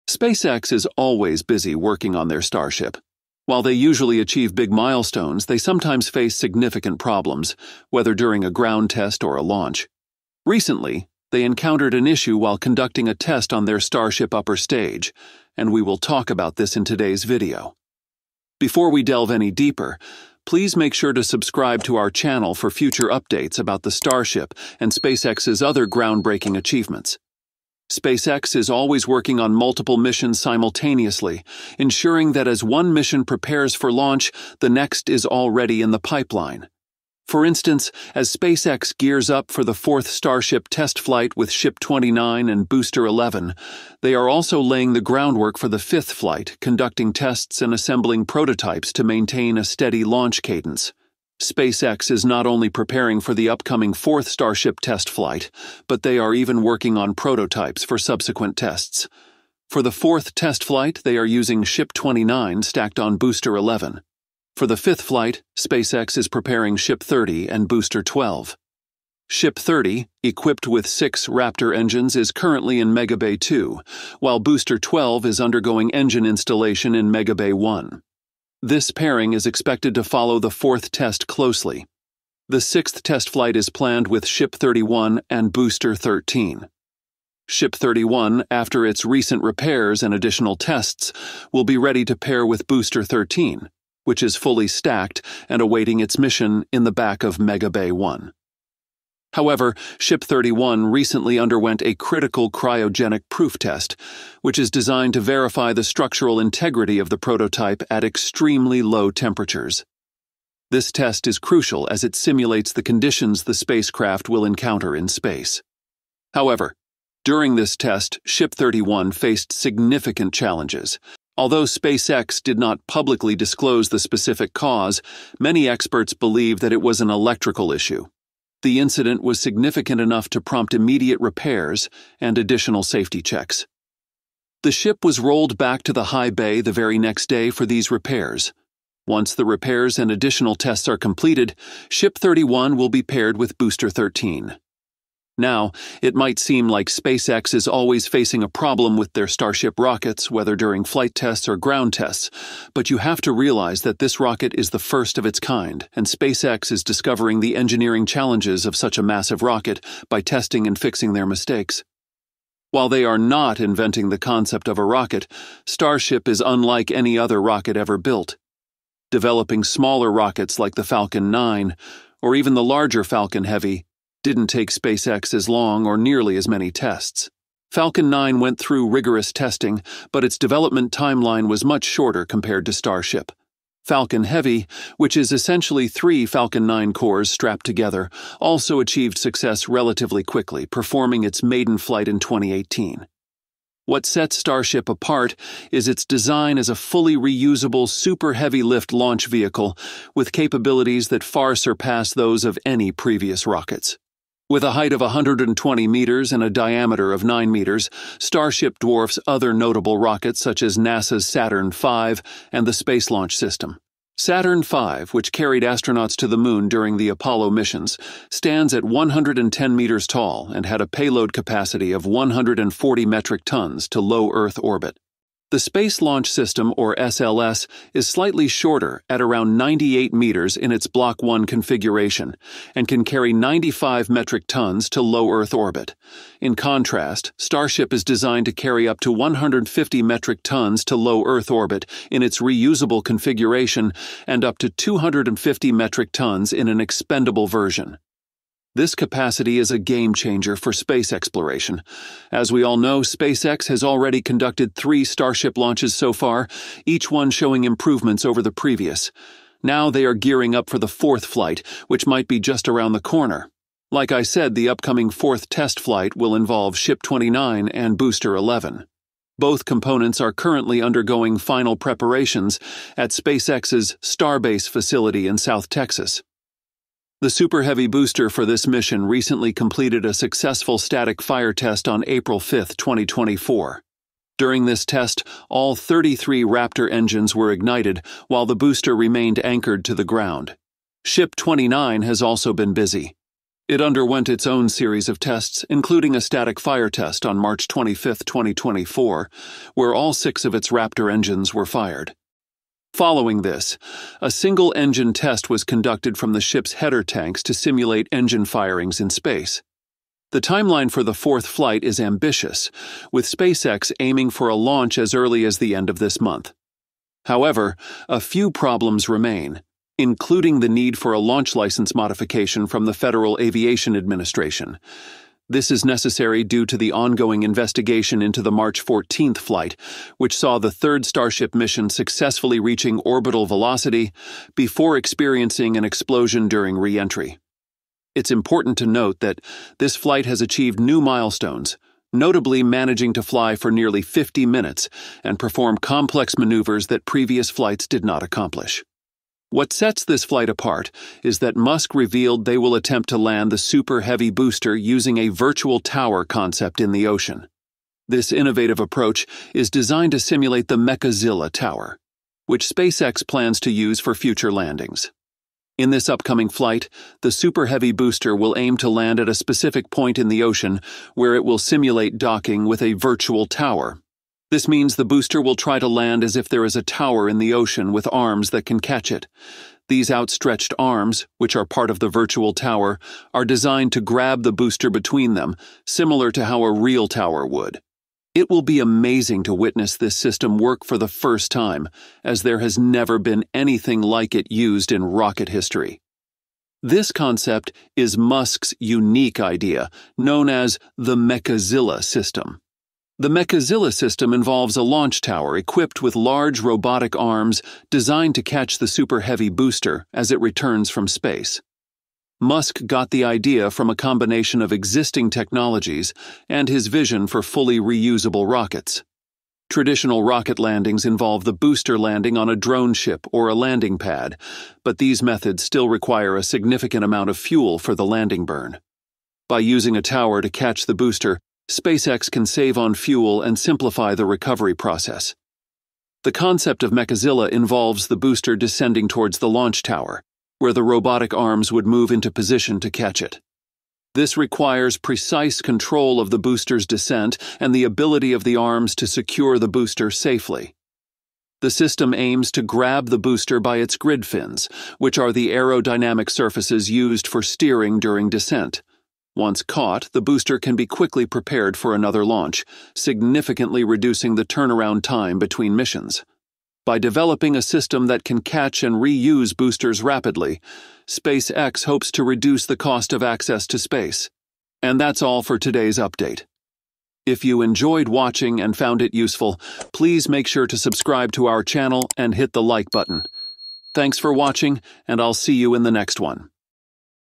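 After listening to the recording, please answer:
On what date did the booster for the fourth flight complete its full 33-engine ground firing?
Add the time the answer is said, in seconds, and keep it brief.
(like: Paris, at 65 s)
April 5, 2024, at 282 s.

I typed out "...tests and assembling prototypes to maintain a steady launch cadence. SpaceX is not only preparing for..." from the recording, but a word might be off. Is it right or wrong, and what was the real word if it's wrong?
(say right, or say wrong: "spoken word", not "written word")
right.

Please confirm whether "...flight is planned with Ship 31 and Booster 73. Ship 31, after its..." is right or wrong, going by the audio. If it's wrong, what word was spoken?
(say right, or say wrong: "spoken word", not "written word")
wrong: "13", not "73".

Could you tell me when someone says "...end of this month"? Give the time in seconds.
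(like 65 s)
315 s.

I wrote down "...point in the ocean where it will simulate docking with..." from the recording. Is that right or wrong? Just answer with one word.
right.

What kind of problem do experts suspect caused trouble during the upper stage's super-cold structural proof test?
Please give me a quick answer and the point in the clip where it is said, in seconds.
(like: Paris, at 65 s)
Electrical issue, at 127 s.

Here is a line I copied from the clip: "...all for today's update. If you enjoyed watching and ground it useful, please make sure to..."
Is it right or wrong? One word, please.
wrong.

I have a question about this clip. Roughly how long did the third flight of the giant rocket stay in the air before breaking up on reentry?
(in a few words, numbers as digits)
Nearly 50 minutes.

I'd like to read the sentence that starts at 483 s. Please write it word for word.
Thanks for watching, and I'll see you in the next one.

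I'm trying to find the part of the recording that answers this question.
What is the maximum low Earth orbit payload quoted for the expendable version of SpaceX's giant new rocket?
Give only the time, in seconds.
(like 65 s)
244 s.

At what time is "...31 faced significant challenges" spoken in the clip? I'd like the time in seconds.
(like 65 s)
118 s.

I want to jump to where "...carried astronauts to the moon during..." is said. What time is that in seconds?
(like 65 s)
215 s.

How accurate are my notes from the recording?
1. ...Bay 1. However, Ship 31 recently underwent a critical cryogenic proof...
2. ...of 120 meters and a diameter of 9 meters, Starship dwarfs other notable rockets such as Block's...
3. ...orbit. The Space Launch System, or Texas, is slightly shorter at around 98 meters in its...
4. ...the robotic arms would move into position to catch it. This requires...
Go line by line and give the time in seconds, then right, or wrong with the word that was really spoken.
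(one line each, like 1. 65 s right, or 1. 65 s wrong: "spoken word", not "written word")
1. 97 s right
2. 204 s wrong: "NASA", not "Block"
3. 224 s wrong: "SLS", not "Texas"
4. 440 s right.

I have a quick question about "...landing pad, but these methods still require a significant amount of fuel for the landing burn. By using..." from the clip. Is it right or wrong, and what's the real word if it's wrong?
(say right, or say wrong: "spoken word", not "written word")
right.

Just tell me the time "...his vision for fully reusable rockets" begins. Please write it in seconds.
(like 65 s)
416 s.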